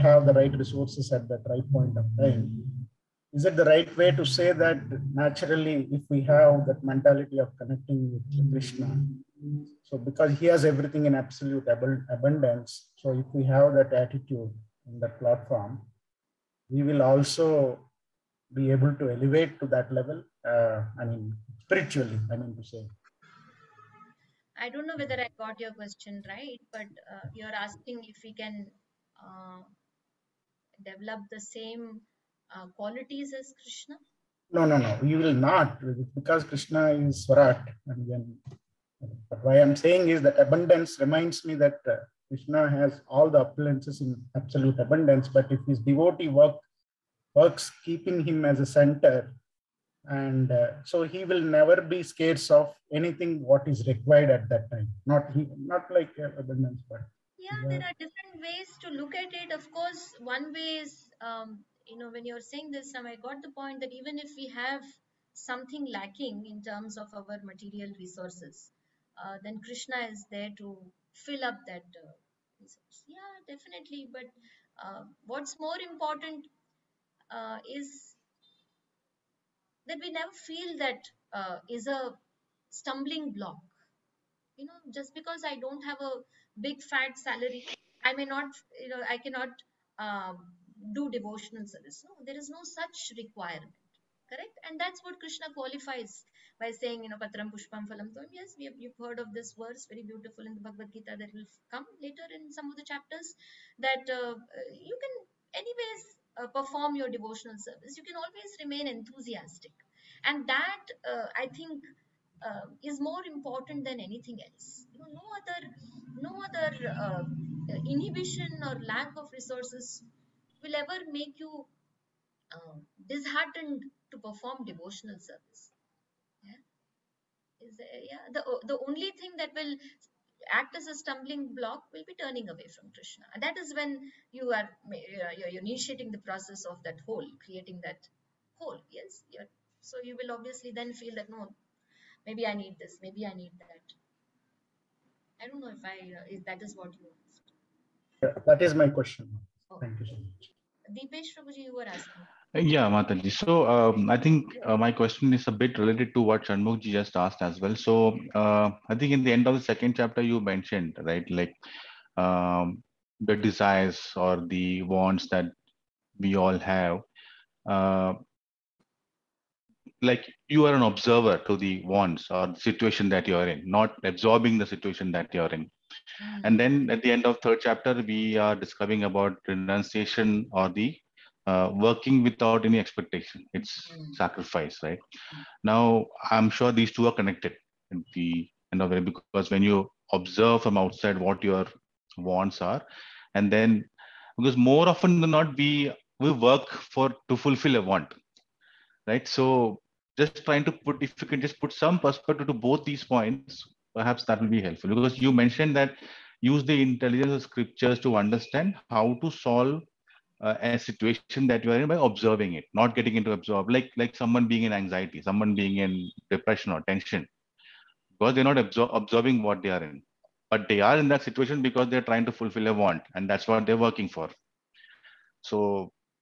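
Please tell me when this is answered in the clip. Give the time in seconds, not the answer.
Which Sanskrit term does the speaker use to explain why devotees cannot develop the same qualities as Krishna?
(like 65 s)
37 s.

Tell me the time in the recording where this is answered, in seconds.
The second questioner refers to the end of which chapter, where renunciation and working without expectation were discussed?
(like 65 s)
177 s.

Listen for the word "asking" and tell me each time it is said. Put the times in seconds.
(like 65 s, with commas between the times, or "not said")
27 s, 151 s.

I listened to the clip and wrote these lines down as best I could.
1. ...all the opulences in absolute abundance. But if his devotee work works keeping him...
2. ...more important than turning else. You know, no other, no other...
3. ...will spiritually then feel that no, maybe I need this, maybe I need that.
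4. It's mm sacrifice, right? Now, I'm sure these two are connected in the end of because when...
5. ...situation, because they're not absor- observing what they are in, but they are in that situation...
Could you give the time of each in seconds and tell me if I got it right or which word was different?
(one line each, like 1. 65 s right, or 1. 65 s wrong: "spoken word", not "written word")
1. 43 s right
2. 113 s wrong: "anything", not "turning"
3. 140 s wrong: "obviously", not "spiritually"
4. 183 s right
5. 216 s wrong: "tension", not "situation".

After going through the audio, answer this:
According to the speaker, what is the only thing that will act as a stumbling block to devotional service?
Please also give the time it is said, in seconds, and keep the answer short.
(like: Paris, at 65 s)
Turning away from Krishna, at 132 s.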